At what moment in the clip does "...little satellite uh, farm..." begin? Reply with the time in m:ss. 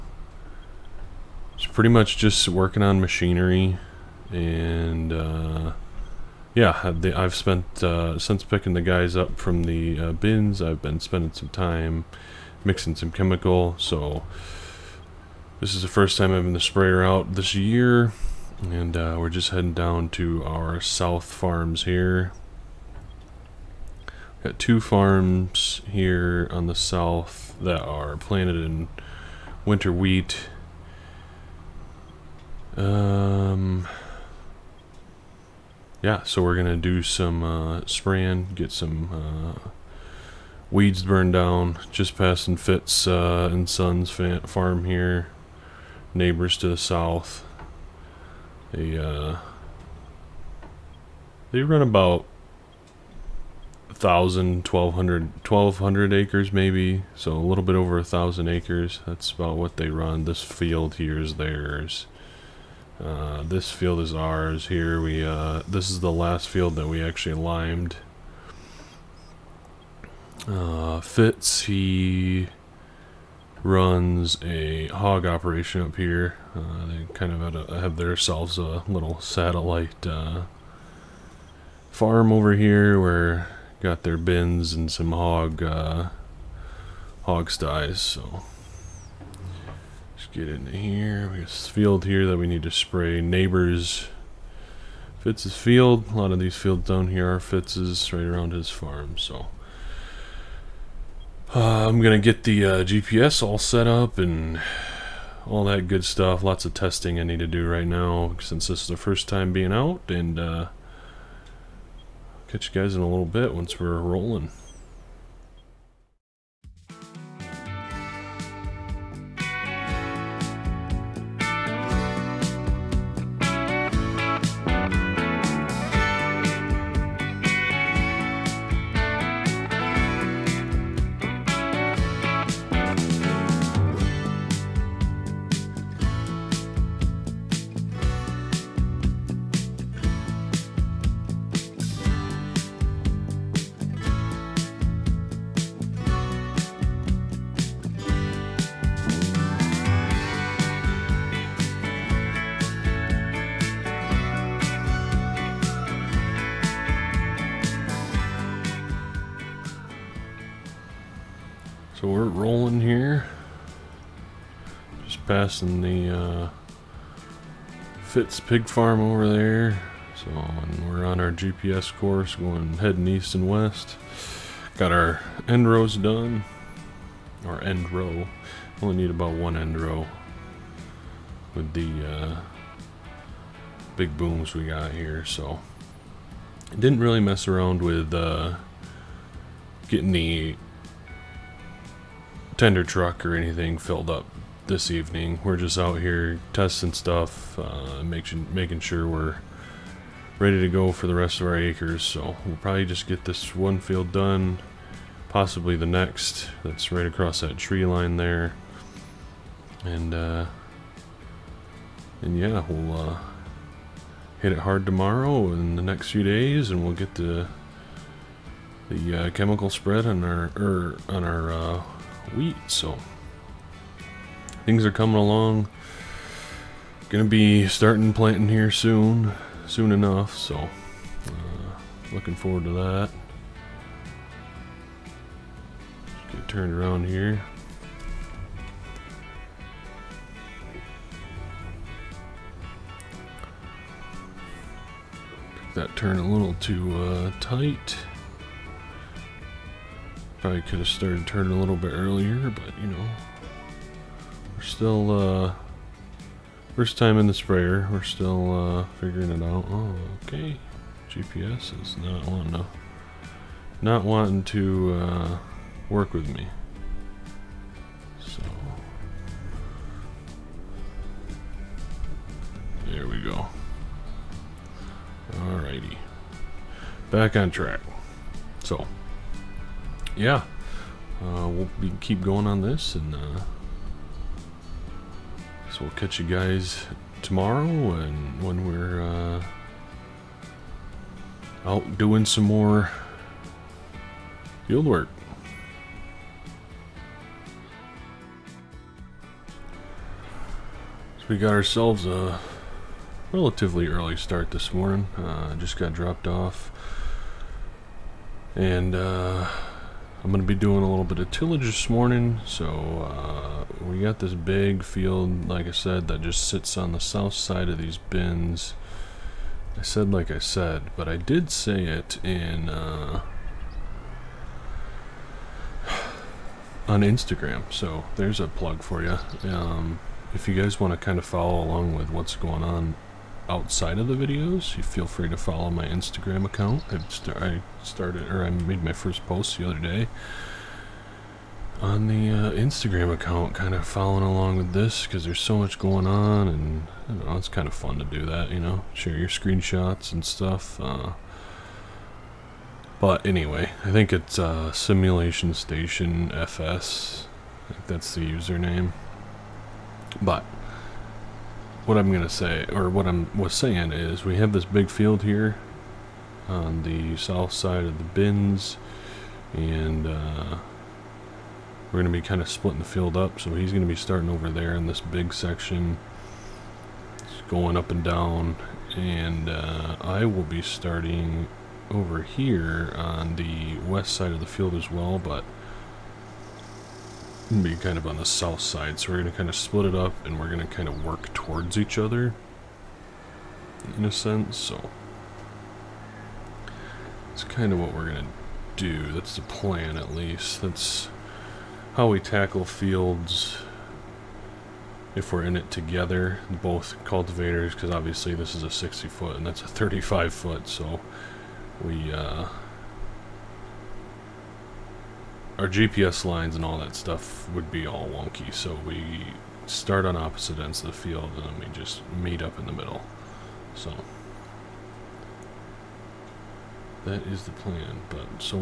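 1:18.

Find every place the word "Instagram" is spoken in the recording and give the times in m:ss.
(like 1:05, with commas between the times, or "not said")
5:27, 5:35, 5:42.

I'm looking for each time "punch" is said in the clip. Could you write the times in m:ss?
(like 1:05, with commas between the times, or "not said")
not said.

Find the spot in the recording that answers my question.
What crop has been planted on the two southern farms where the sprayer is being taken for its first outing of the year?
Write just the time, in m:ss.
0:29.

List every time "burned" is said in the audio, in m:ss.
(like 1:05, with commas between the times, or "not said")
0:41.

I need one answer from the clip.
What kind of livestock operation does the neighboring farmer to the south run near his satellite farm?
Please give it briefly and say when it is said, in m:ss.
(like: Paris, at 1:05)
hog operation, at 1:14.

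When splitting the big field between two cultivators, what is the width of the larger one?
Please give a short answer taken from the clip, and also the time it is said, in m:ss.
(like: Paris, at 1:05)
60 foot, at 6:48.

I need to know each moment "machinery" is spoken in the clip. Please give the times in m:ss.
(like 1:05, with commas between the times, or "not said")
0:02.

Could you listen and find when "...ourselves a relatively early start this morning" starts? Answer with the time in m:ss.
5:01.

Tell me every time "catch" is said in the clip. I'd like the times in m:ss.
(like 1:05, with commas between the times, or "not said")
1:52, 4:45.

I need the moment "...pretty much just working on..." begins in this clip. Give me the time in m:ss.
0:01.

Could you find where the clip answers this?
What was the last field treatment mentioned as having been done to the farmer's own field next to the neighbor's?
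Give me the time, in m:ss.
1:07.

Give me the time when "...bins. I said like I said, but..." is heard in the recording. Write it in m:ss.
5:17.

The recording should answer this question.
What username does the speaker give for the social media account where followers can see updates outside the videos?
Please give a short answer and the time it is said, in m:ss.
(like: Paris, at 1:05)
Simulation Station FS, at 5:54.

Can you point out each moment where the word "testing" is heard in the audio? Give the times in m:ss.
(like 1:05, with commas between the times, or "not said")
1:46, 3:16.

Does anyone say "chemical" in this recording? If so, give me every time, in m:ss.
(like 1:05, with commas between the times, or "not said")
0:13, 3:39.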